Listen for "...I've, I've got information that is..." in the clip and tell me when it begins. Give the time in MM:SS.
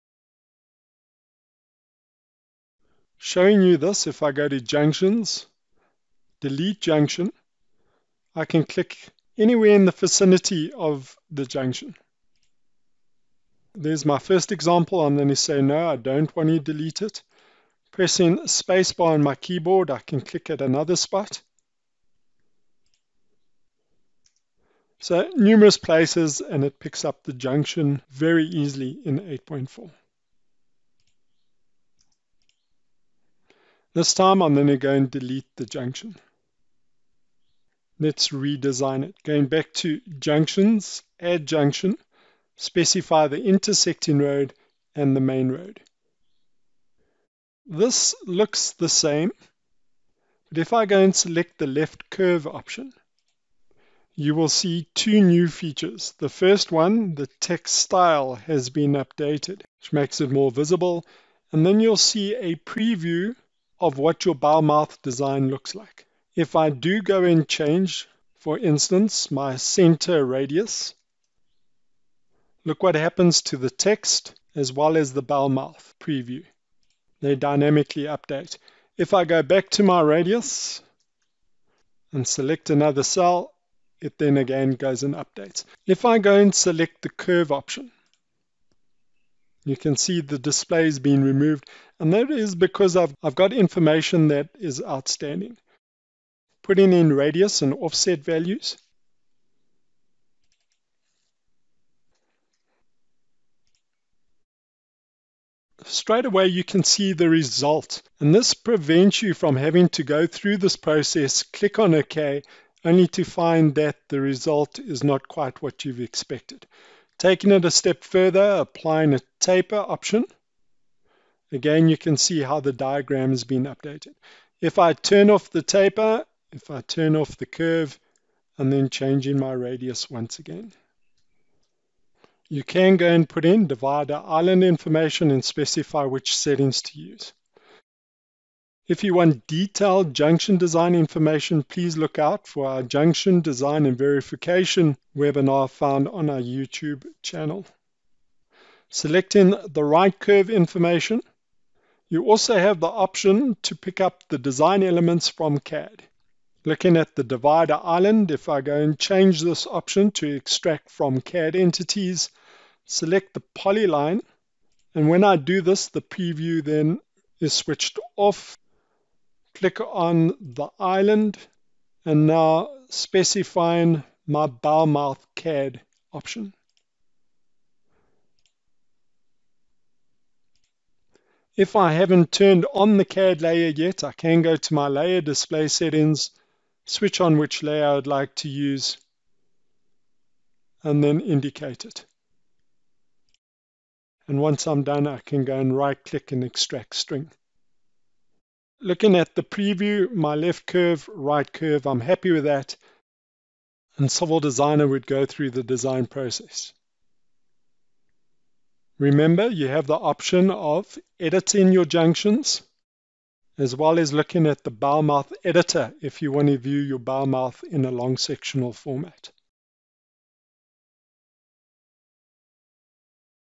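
01:32.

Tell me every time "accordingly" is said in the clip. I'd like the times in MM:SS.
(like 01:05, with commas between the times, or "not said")
not said.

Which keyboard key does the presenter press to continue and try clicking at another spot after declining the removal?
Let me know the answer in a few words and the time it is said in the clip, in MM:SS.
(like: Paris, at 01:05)
Spacebar, at 00:18.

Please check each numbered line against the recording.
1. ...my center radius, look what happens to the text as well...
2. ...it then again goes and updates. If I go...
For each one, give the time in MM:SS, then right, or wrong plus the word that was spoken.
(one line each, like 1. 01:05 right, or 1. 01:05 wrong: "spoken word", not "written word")
1. 01:09 right
2. 01:23 right.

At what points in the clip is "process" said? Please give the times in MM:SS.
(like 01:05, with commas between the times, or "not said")
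01:50, 03:26.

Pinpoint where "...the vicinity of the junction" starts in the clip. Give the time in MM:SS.
00:09.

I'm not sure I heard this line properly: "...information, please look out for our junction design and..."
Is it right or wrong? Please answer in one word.
right.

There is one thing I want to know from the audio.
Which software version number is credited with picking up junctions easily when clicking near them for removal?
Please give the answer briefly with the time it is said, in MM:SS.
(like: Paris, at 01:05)
8.4, at 00:29.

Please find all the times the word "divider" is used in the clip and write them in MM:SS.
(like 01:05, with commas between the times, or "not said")
02:13, 02:37.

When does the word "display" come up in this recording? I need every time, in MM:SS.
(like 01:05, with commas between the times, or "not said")
01:30, 03:05.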